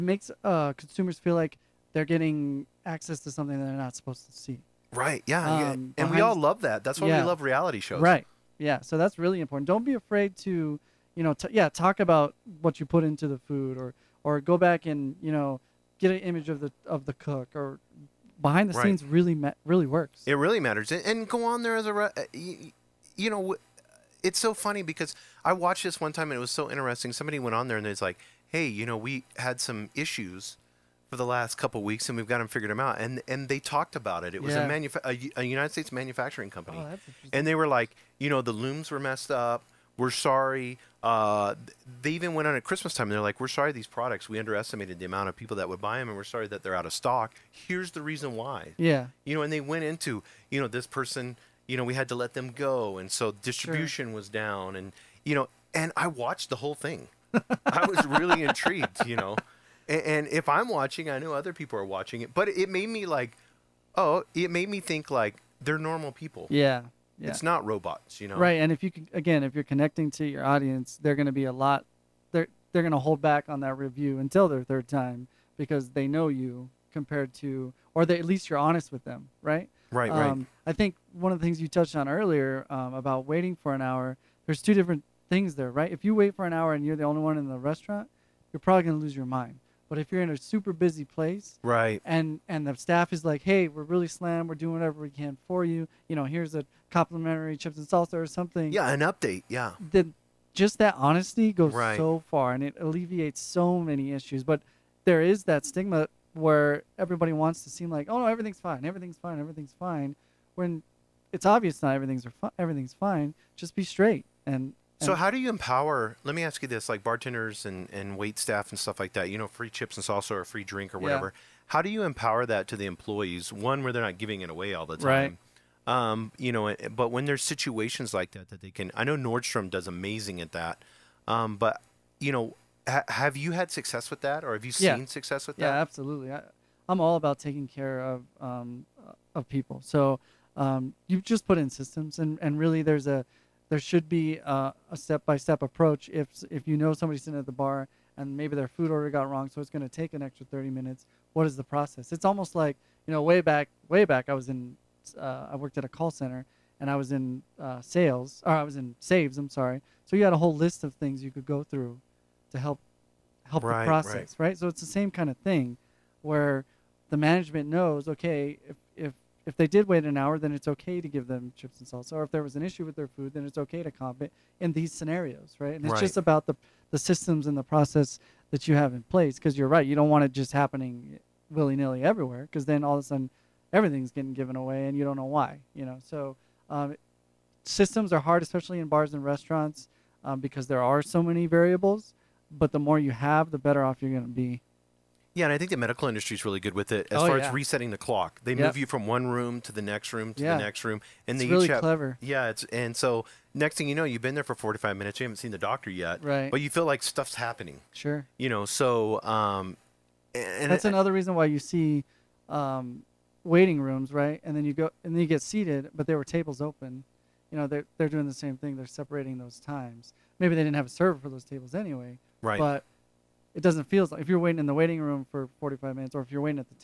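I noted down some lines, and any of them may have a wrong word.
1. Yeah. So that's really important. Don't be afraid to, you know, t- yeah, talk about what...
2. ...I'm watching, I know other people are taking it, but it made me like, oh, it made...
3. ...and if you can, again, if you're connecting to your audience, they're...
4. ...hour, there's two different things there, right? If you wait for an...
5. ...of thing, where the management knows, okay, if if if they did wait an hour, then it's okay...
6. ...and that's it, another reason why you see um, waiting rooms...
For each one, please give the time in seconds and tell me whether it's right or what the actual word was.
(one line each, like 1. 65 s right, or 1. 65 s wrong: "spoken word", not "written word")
1. 8 s right
2. 60 s wrong: "watching", not "taking"
3. 68 s right
4. 83 s right
5. 165 s right
6. 210 s right.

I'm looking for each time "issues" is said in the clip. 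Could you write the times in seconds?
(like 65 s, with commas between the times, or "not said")
29 s, 104 s, 172 s.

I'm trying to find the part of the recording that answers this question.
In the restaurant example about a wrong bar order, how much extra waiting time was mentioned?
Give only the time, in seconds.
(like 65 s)
150 s.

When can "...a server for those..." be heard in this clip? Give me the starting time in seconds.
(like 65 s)
220 s.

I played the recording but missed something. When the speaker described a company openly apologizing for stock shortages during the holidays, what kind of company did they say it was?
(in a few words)
United States manufacturing company.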